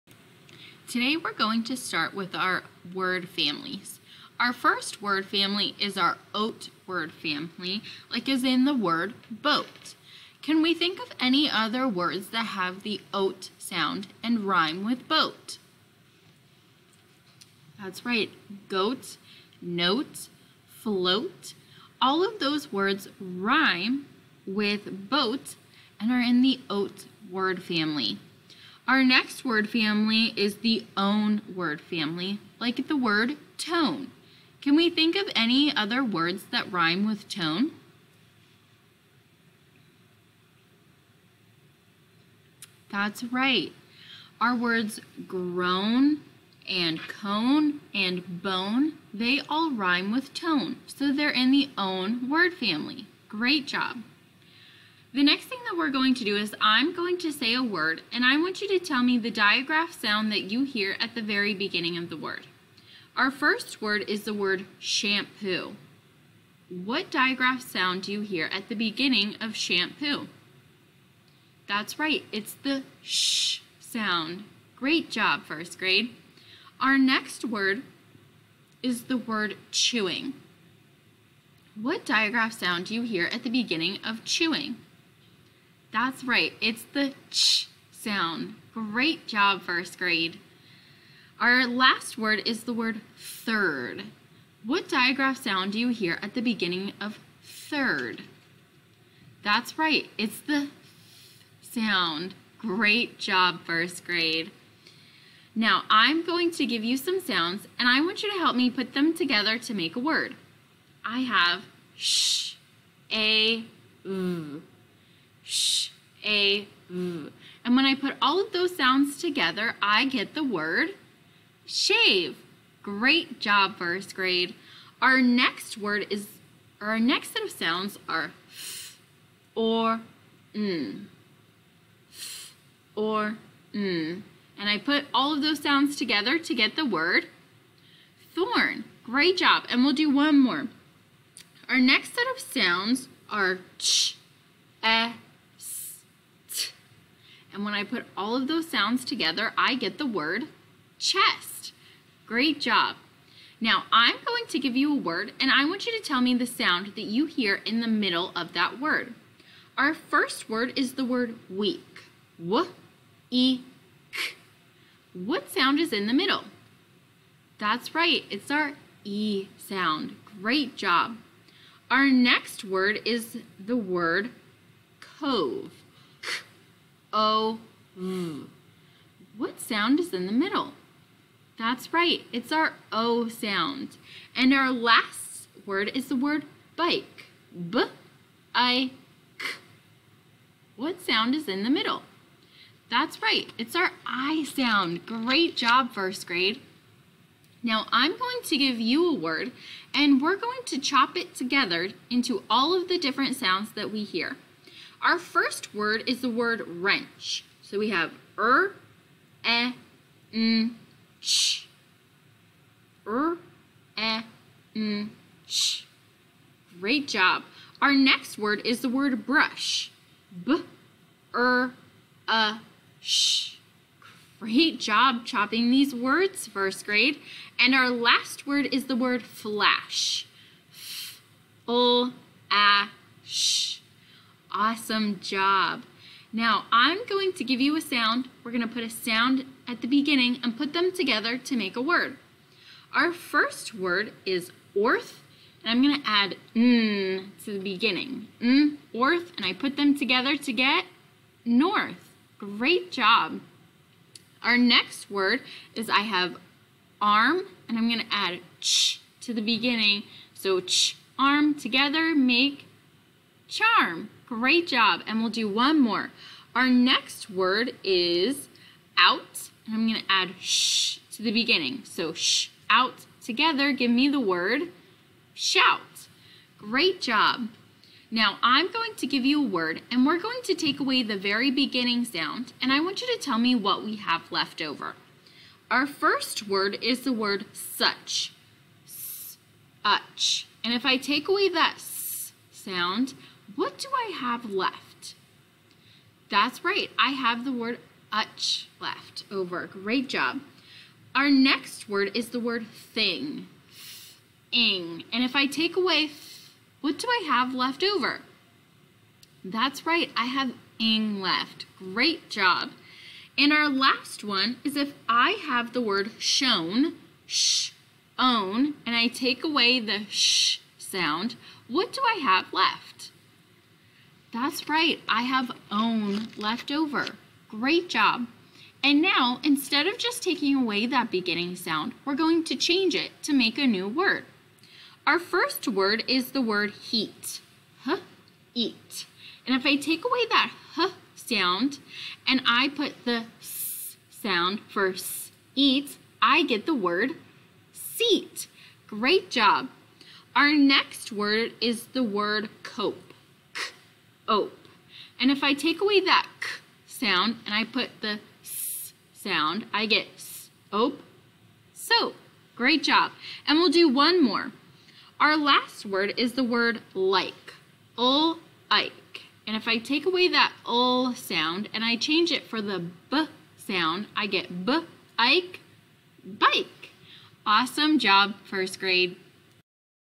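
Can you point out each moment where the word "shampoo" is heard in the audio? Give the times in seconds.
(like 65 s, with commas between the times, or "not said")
64 s, 69 s.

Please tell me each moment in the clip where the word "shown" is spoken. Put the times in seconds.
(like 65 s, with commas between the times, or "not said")
316 s.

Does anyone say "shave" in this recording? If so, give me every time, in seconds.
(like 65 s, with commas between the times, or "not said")
121 s.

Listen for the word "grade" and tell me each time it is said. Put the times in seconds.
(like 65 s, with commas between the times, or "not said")
75 s, 89 s, 104 s, 124 s, 196 s, 226 s, 378 s.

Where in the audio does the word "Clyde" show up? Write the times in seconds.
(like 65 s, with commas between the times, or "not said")
not said.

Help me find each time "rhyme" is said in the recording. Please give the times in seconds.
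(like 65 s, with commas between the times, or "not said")
14 s, 23 s, 36 s, 49 s.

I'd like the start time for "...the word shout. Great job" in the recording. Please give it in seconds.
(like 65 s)
274 s.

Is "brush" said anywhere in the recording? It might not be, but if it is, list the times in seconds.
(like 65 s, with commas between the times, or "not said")
219 s.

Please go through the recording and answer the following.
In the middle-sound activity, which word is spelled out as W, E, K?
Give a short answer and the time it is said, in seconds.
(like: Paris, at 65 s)
weak, at 160 s.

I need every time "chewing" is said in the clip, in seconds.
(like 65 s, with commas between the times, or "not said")
79 s, 84 s.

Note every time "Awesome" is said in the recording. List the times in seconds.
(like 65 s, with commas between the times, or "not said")
234 s, 377 s.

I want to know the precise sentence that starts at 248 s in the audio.
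N, orth, and I put them together to get north.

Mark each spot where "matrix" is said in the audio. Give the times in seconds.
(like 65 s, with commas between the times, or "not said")
not said.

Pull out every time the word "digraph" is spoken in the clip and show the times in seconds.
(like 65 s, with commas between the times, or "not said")
59 s, 67 s, 82 s, 94 s.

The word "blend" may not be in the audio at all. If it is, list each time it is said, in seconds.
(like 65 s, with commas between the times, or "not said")
not said.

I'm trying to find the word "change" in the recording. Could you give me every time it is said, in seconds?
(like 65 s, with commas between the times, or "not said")
332 s, 371 s.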